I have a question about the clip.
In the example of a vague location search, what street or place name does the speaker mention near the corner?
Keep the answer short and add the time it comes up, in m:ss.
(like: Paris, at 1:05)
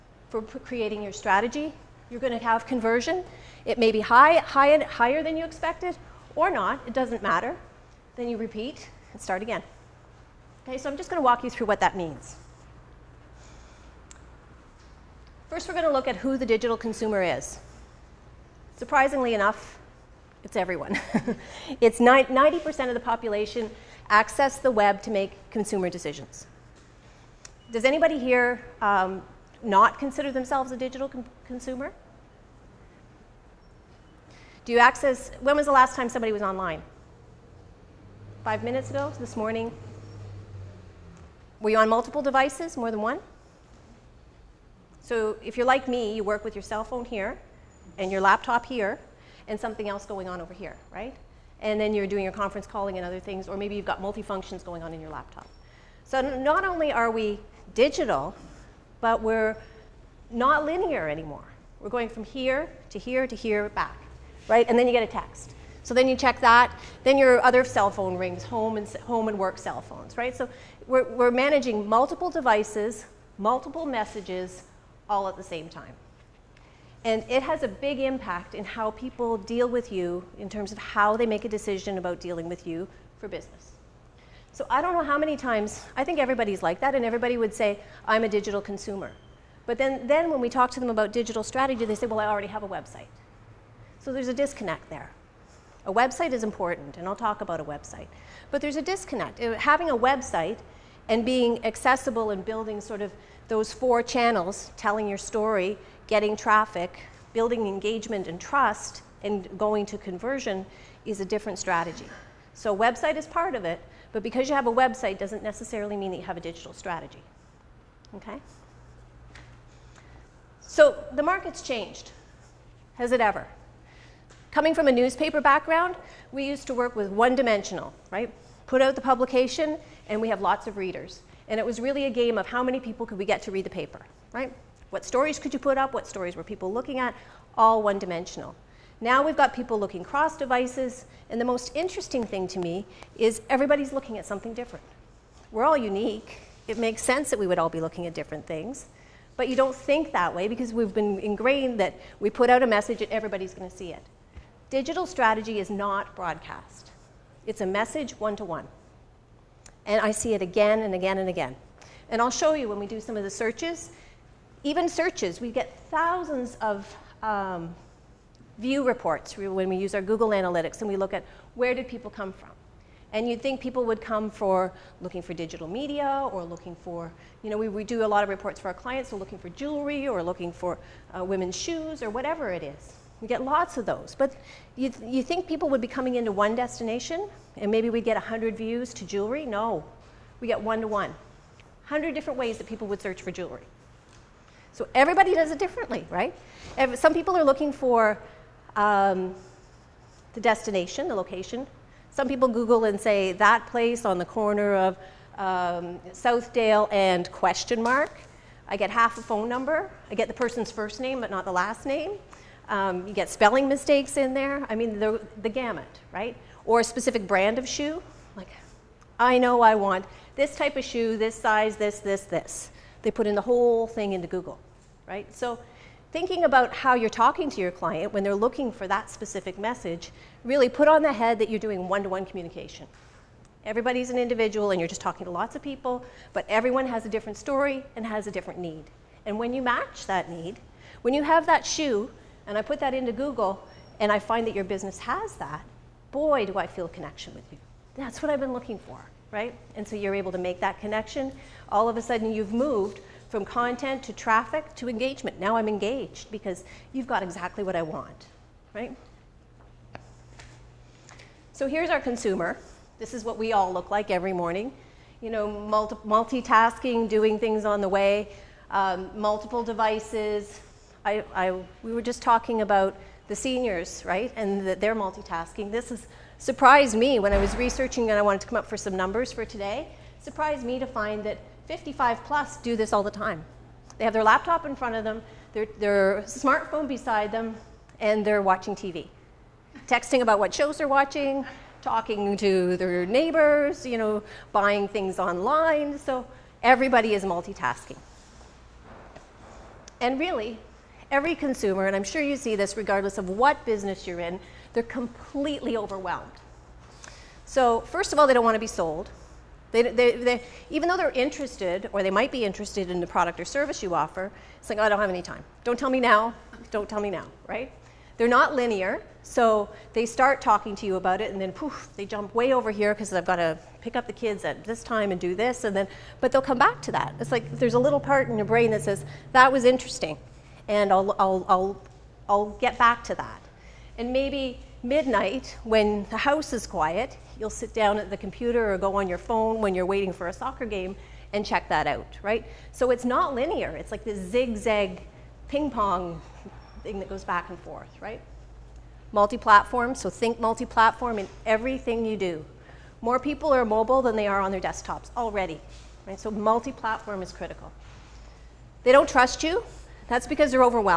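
Southdale, at 3:26.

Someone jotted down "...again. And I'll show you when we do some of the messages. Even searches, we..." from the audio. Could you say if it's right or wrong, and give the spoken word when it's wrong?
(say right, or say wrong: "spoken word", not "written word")
wrong: "searches", not "messages".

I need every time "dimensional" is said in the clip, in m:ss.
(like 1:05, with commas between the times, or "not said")
2:07, 2:17.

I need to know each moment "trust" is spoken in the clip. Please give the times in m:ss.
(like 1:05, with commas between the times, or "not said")
1:48, 5:59.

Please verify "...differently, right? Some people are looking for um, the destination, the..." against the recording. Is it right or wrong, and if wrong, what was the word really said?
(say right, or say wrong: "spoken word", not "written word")
right.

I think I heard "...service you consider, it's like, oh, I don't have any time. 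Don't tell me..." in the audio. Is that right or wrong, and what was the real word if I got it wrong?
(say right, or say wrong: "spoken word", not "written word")
wrong: "offer", not "consider".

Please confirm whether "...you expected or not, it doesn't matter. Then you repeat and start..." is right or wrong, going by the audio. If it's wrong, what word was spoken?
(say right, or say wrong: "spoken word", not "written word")
right.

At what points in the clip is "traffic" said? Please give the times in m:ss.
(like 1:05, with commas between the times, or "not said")
1:46, 4:14.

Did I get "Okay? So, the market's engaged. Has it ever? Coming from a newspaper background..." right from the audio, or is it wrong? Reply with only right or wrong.
wrong.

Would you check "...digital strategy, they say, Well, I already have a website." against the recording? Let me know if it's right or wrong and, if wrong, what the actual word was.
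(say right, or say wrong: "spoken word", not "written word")
right.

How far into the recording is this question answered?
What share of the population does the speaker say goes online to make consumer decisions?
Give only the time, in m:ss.
0:21.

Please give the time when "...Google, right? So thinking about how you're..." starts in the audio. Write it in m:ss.
3:44.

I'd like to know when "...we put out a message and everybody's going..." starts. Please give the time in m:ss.
2:32.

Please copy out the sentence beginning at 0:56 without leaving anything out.
So not only are we digital, but we're not linear anymore.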